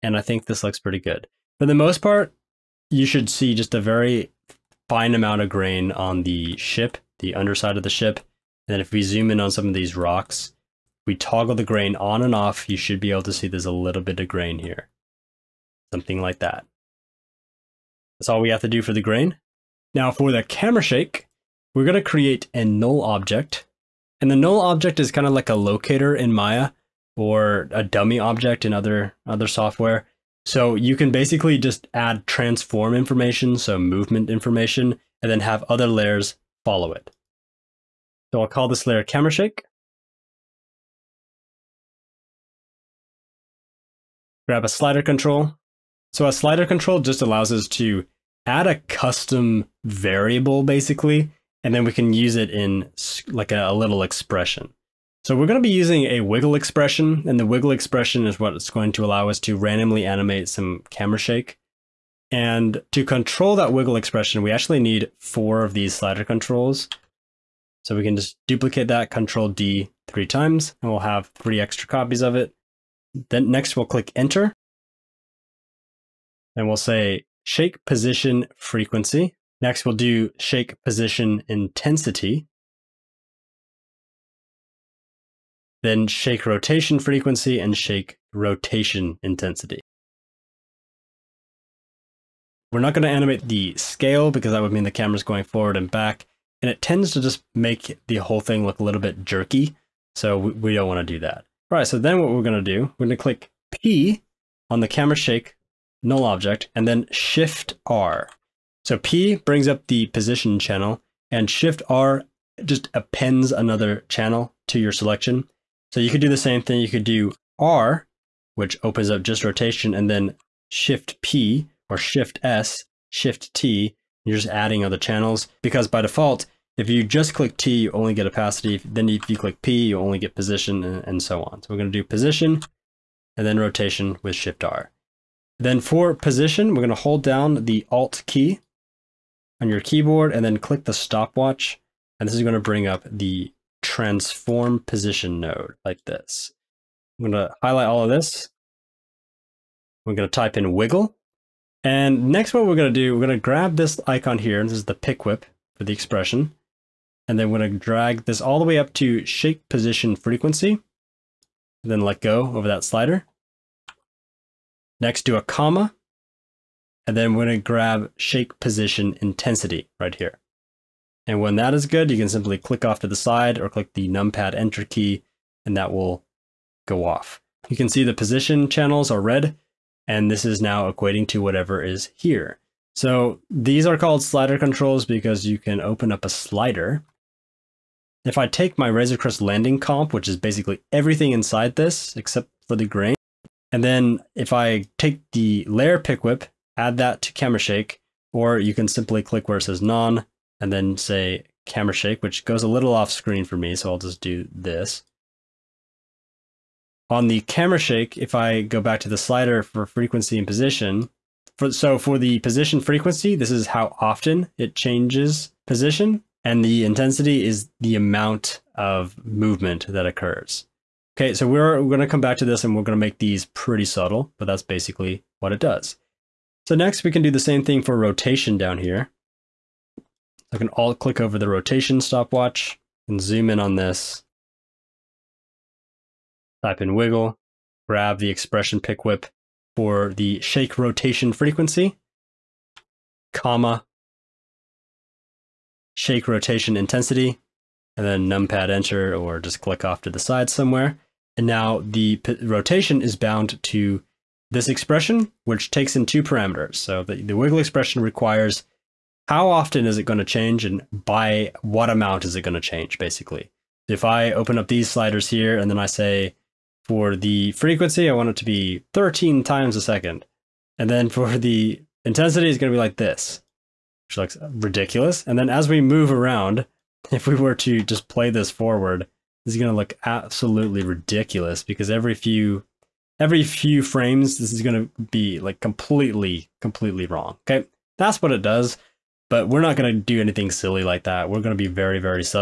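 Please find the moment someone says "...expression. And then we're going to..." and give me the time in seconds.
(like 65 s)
155 s.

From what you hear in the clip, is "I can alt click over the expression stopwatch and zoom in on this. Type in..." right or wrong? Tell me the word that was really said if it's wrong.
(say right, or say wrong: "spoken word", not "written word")
wrong: "rotation", not "expression".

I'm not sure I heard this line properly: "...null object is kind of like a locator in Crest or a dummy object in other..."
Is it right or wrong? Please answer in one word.
wrong.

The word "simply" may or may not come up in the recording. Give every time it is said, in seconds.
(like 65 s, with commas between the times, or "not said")
172 s, 198 s.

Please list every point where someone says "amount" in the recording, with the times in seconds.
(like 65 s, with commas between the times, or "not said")
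5 s, 217 s, 261 s.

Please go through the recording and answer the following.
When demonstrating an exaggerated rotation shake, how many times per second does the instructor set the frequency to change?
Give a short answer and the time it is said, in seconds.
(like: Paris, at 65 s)
13, at 268 s.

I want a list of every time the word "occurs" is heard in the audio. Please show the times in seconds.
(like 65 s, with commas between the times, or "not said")
220 s.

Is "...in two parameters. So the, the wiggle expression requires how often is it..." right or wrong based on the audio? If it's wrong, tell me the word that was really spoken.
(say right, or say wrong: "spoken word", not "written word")
right.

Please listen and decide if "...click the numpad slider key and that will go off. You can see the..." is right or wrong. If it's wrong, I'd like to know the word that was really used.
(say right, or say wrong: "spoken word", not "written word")
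wrong: "enter", not "slider".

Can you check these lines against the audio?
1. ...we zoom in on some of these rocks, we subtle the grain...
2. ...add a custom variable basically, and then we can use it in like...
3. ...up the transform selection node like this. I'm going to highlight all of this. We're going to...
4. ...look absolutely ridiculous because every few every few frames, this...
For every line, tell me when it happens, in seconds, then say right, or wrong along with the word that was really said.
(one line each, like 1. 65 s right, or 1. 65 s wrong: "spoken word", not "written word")
1. 8 s wrong: "toggle", not "subtle"
2. 48 s right
3. 142 s wrong: "position", not "selection"
4. 279 s right.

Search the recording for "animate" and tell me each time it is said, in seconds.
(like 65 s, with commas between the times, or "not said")
60 s, 93 s.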